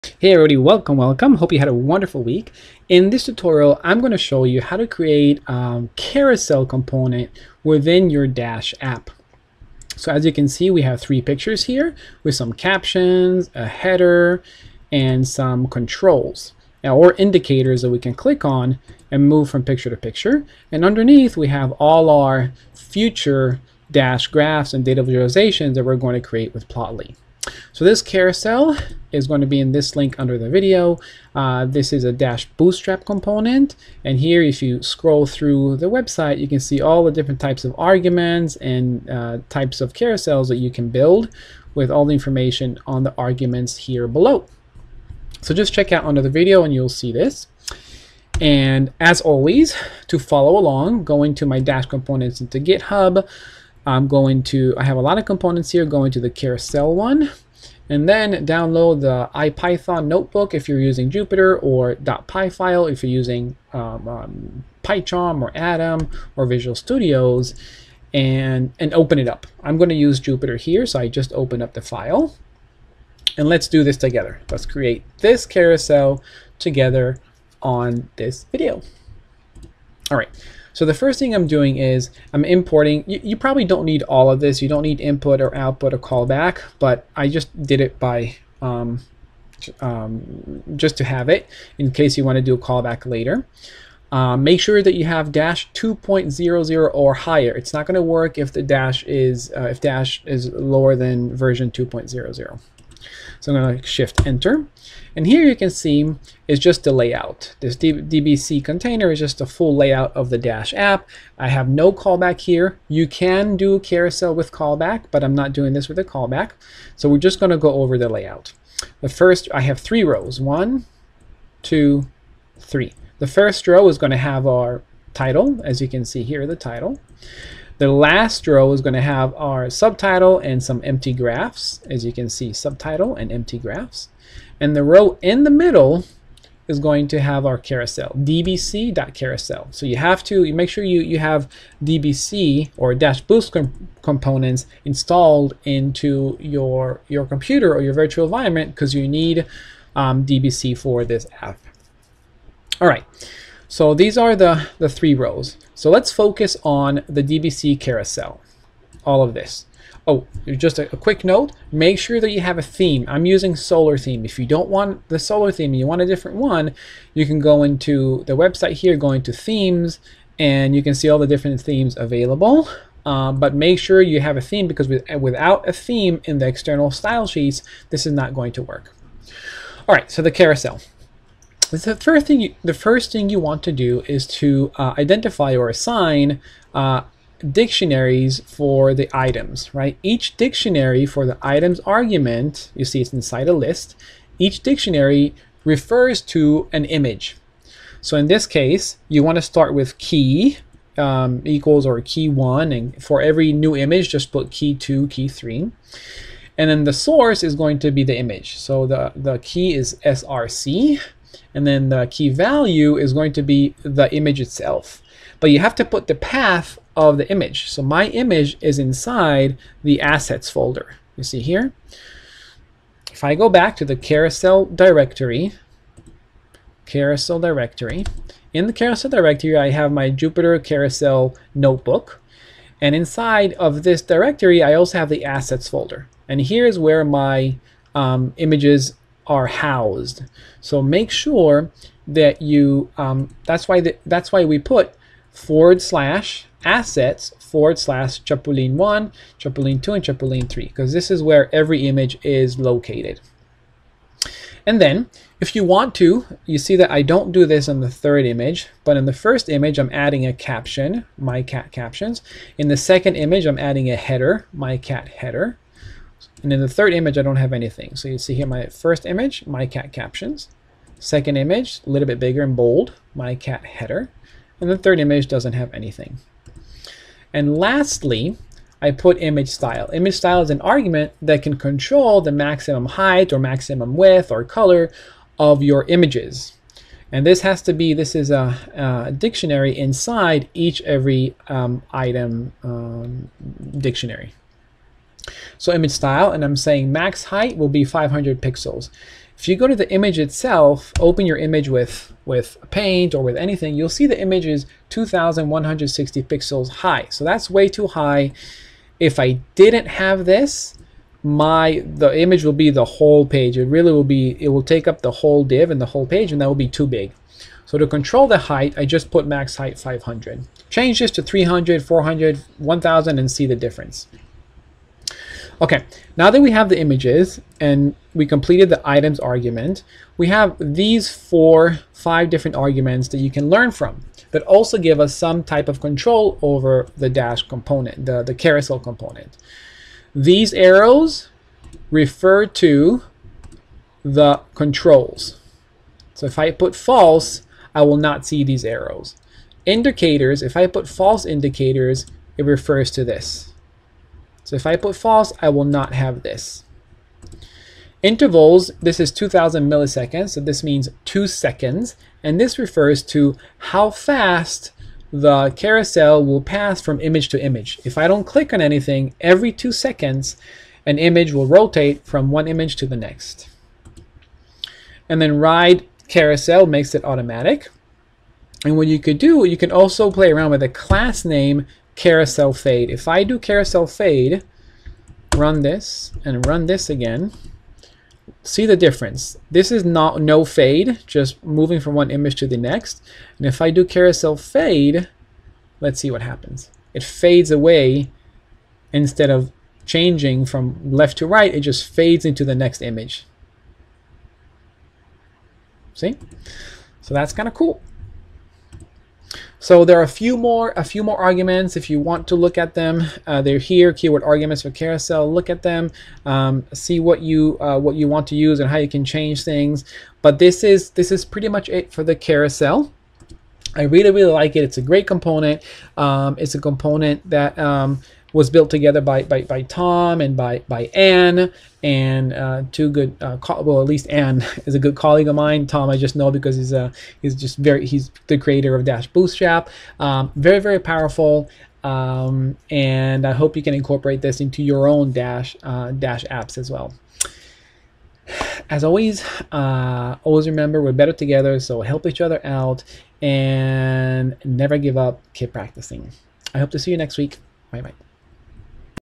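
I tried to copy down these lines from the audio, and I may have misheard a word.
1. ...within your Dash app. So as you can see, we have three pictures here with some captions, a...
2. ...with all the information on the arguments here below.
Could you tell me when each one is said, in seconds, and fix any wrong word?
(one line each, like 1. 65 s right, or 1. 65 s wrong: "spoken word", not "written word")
1. 7 s right
2. 41 s right.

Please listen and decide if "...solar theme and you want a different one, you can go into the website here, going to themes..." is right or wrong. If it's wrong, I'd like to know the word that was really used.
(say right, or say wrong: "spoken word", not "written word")
right.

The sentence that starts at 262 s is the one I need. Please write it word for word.
In the second image, I'm adding a header, my cat header.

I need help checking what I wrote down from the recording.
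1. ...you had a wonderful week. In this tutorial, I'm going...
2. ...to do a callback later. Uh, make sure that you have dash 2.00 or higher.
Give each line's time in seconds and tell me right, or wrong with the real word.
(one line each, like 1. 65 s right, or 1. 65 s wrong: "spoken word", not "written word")
1. 1 s right
2. 92 s right.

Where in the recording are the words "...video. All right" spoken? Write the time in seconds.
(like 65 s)
78 s.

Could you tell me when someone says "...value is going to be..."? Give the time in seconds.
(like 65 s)
212 s.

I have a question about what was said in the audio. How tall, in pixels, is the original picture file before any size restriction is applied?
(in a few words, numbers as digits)
2,160.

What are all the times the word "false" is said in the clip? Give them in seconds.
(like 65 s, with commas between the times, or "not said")
346 s, 350 s, 354 s.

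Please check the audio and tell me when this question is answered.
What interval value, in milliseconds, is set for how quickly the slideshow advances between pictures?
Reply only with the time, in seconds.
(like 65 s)
359 s.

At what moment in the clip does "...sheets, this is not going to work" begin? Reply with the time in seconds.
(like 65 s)
177 s.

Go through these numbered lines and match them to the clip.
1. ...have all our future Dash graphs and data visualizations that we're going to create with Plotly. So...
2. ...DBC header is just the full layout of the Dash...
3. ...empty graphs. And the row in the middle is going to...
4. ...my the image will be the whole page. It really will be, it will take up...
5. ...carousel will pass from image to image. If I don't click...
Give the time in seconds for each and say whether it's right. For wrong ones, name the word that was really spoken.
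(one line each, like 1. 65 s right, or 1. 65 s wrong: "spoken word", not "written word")
1. 21 s right
2. 107 s wrong: "container", not "header"
3. 133 s right
4. 311 s right
5. 365 s right.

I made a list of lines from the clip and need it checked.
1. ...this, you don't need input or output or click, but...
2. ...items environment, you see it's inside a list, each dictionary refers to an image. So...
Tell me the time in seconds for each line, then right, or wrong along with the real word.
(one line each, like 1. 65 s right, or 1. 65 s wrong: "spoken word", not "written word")
1. 84 s wrong: "callback", not "click"
2. 191 s wrong: "argument", not "environment".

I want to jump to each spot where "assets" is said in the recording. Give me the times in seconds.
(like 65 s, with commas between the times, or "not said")
220 s, 235 s, 246 s.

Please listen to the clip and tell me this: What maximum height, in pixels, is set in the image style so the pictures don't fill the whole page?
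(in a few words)
500.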